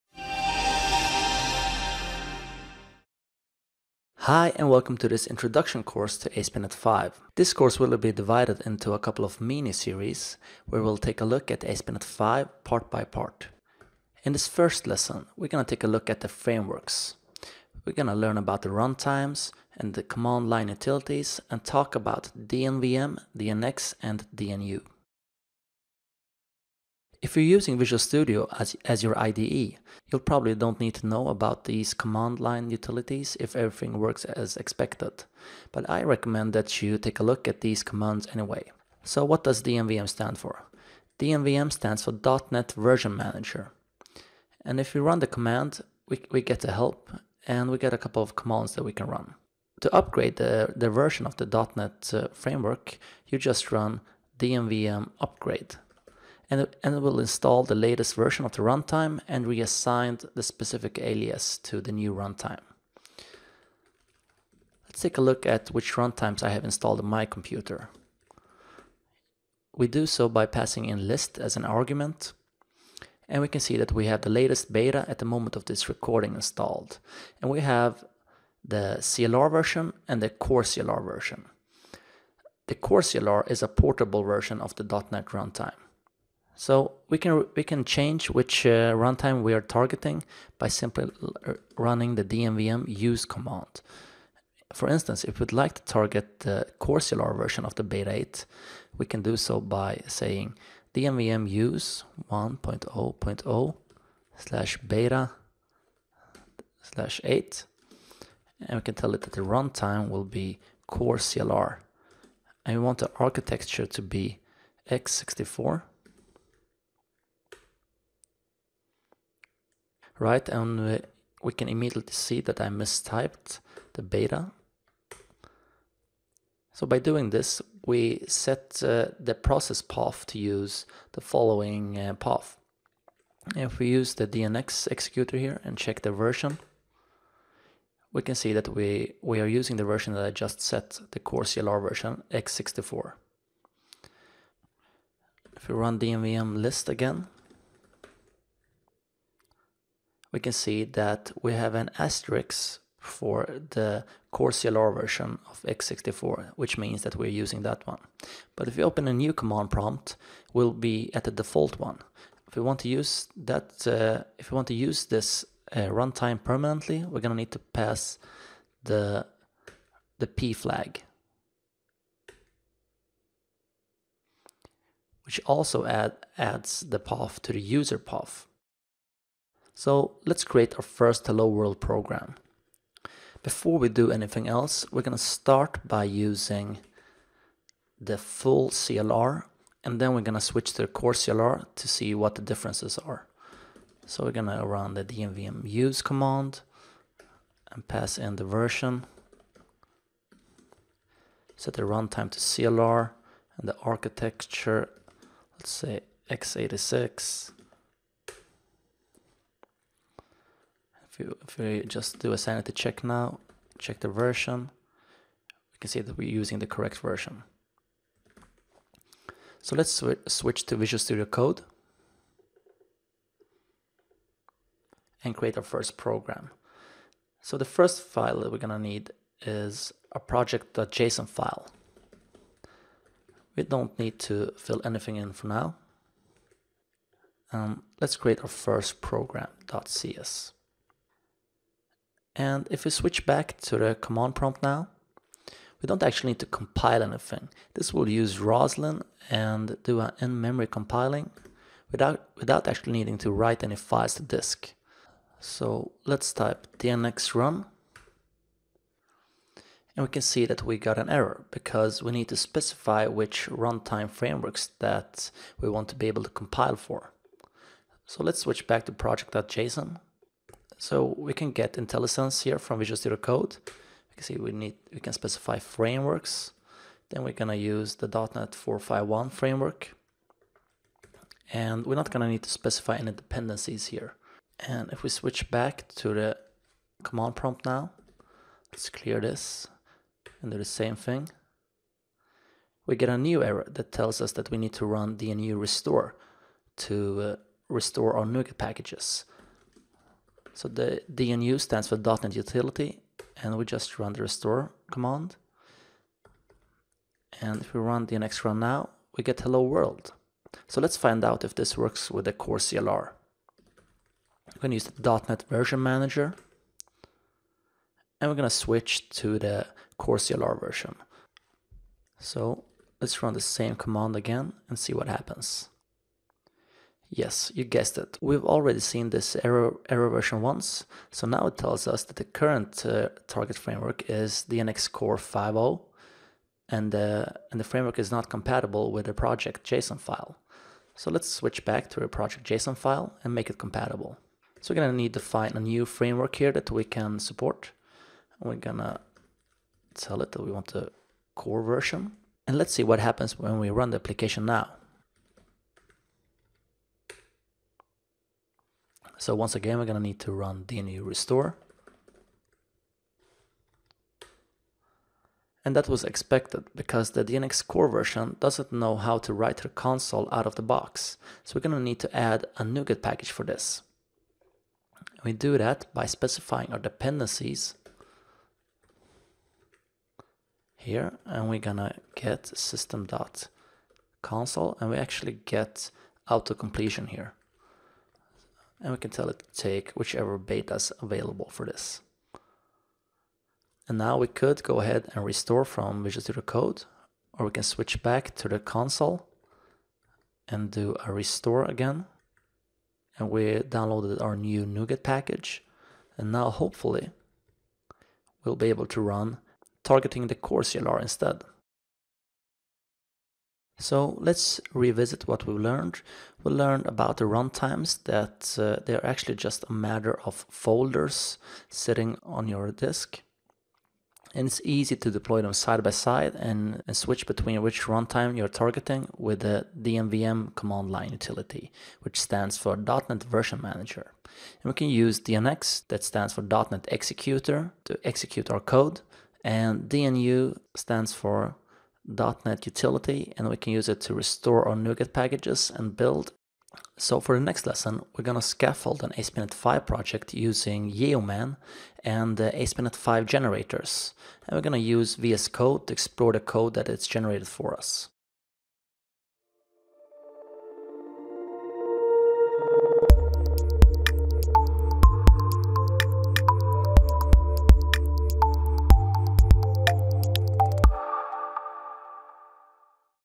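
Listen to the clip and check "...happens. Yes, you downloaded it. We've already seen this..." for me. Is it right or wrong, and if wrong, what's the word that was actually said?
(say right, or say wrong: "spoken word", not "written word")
wrong: "guessed", not "downloaded".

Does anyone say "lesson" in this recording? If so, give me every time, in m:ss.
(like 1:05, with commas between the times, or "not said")
0:14, 7:27.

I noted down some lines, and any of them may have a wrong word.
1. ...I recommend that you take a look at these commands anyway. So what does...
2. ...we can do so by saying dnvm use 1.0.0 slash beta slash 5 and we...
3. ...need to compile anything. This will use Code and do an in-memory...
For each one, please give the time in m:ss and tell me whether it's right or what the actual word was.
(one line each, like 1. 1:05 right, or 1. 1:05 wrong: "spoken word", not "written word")
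1. 0:35 right
2. 1:38 wrong: "8", not "5"
3. 4:06 wrong: "Roslyn", not "Code".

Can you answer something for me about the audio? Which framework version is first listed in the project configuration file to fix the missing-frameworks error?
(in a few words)
.NET 4.5.1.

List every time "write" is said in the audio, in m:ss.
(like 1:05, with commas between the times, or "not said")
4:13, 6:09.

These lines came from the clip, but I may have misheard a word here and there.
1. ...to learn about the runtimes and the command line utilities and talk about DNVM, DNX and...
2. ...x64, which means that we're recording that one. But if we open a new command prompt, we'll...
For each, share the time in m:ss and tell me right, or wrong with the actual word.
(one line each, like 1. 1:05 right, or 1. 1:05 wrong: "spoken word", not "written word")
1. 0:18 right
2. 2:35 wrong: "using", not "recording".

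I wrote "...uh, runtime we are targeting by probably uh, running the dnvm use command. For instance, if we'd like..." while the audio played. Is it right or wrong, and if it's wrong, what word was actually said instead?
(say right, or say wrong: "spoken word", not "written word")
wrong: "simply", not "probably".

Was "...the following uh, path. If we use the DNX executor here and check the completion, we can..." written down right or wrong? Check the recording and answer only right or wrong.
wrong.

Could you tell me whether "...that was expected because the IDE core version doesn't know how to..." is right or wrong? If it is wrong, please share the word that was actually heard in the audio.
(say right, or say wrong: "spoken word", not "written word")
wrong: "DNX", not "IDE".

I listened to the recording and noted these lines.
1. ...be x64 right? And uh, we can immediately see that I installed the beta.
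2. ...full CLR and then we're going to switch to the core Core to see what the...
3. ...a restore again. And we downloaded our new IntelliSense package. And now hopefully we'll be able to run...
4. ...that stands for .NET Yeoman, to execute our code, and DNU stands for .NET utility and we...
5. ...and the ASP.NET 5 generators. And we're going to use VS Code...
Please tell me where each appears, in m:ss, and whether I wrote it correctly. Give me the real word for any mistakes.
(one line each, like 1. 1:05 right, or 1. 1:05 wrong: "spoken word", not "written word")
1. 1:54 wrong: "mistyped", not "installed"
2. 3:08 wrong: "CLR", not "Core"
3. 6:41 wrong: "NuGet", not "IntelliSense"
4. 7:15 wrong: "Executor", not "Yeoman"
5. 7:32 right.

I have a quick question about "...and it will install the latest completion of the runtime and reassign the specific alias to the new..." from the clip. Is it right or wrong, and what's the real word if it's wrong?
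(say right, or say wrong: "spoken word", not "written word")
wrong: "version", not "completion".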